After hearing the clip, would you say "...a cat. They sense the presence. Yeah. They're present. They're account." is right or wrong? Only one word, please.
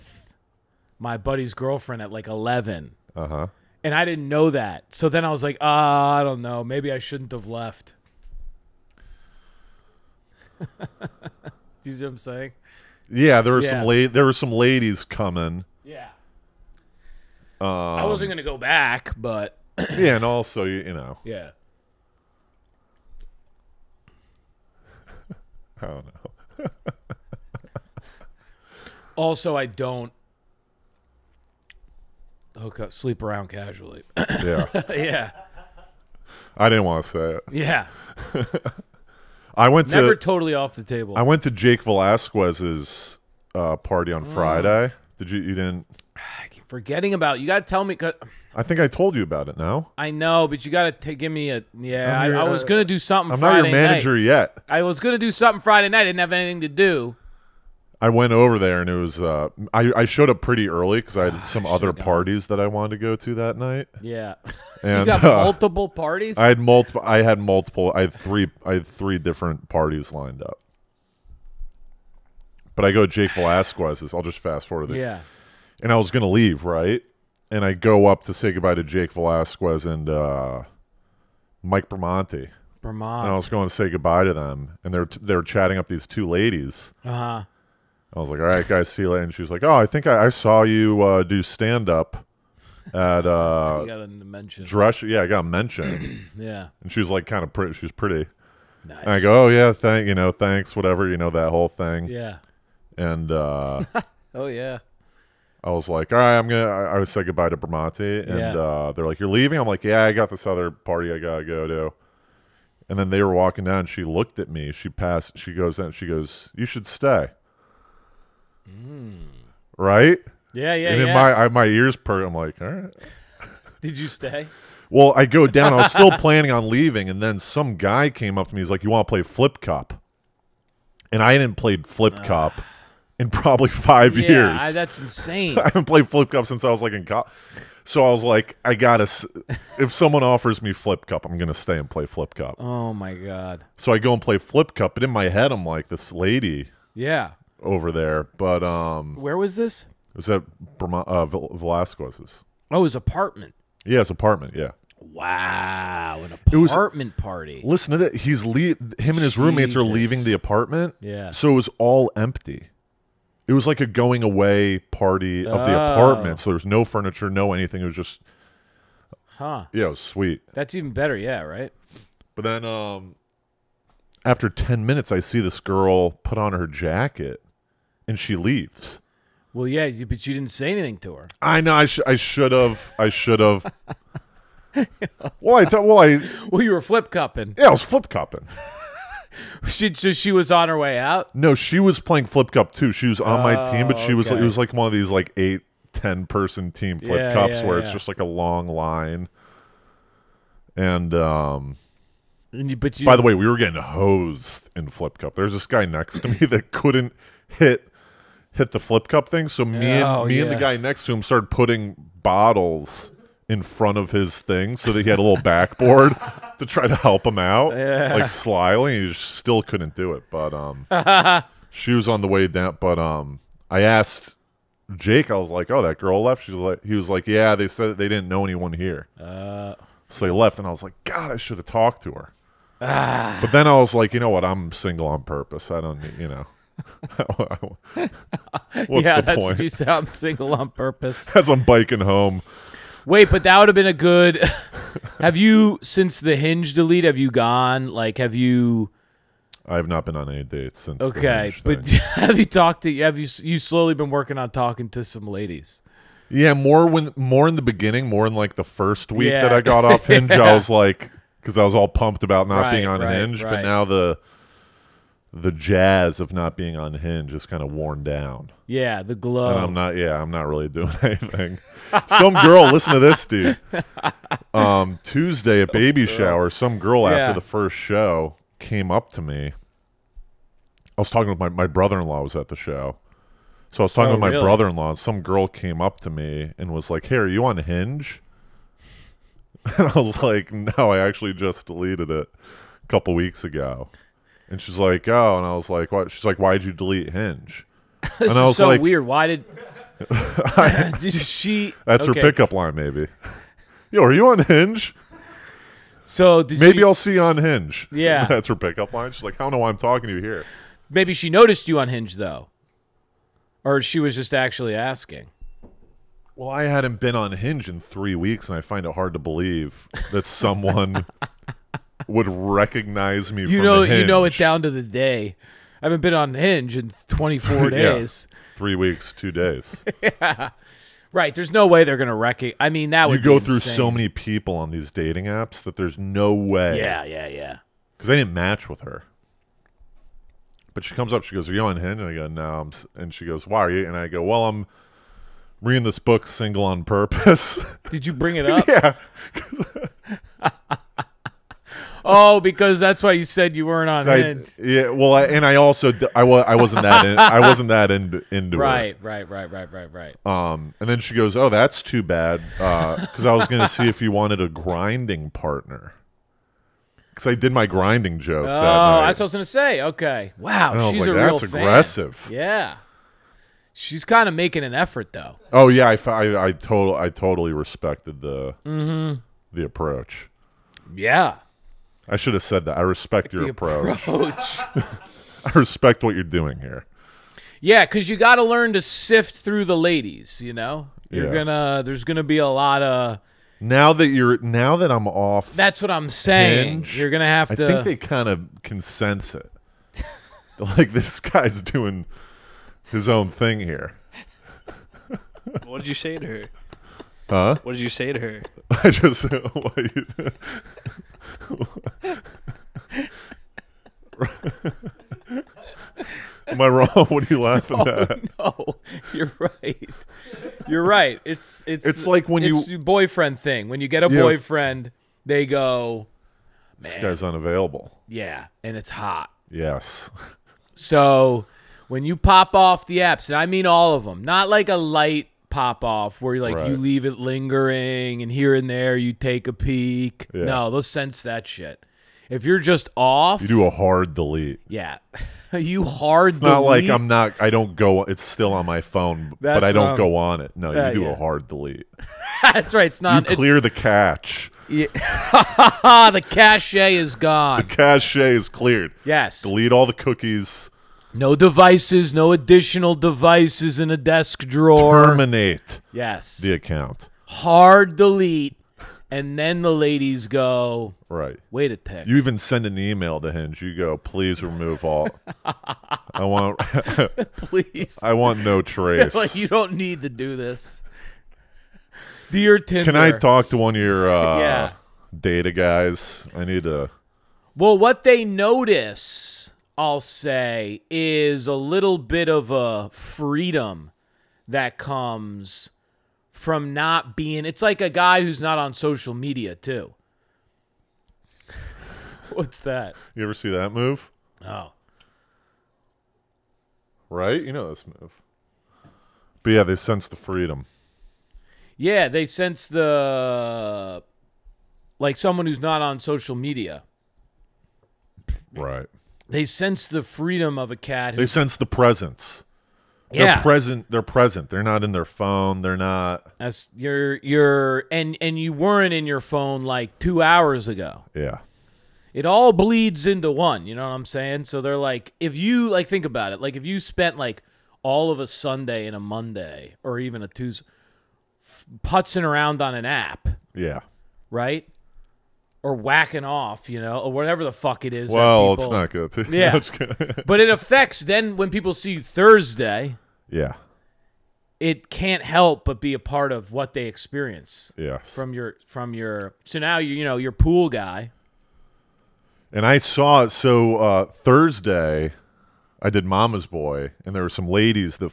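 wrong.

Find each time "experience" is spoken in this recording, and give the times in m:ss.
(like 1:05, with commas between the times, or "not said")
9:16.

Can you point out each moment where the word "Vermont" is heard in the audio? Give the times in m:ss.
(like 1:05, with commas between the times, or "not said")
1:22, 2:30.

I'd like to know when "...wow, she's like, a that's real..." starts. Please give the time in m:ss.
6:10.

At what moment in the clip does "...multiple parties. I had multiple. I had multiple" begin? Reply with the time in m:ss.
1:05.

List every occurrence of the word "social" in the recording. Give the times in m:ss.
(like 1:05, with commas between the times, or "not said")
8:18, 8:35.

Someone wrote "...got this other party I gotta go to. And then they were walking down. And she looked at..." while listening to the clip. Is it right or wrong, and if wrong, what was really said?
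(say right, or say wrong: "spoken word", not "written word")
right.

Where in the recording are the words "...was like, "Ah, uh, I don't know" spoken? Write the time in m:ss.
0:05.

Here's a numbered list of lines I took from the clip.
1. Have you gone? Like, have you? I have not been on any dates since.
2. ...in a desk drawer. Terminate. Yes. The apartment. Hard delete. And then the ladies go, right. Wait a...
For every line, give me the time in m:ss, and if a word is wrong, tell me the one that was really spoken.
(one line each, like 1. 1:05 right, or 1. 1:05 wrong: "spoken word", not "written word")
1. 4:07 right
2. 7:43 wrong: "account", not "apartment".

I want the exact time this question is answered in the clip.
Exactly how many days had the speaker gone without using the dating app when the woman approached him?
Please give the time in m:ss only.
5:27.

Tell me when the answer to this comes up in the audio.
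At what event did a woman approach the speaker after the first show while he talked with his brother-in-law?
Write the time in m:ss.
4:35.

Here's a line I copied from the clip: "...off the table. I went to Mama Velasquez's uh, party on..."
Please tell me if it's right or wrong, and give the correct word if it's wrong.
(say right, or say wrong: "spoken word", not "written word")
wrong: "Jake", not "Mama".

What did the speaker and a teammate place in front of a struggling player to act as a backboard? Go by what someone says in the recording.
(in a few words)
Bottles.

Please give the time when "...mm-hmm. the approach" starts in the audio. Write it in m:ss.
6:18.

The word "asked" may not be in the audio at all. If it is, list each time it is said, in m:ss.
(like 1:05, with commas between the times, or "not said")
3:43.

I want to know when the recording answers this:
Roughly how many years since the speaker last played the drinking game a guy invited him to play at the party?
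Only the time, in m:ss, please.
2:13.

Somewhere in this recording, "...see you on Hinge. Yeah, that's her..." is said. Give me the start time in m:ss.
5:06.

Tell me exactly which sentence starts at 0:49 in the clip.
I know, but you got to give me a yeah.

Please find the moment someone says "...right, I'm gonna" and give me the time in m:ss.
1:46.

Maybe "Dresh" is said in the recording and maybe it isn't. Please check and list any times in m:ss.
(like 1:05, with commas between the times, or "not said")
1:34.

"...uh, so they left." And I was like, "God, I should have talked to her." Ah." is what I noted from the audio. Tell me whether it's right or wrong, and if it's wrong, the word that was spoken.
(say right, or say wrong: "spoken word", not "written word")
right.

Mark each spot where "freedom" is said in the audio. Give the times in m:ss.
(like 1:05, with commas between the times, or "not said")
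8:12, 8:30, 8:40.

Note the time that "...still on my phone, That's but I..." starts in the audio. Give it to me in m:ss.
7:28.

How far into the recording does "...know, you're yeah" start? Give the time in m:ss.
6:30.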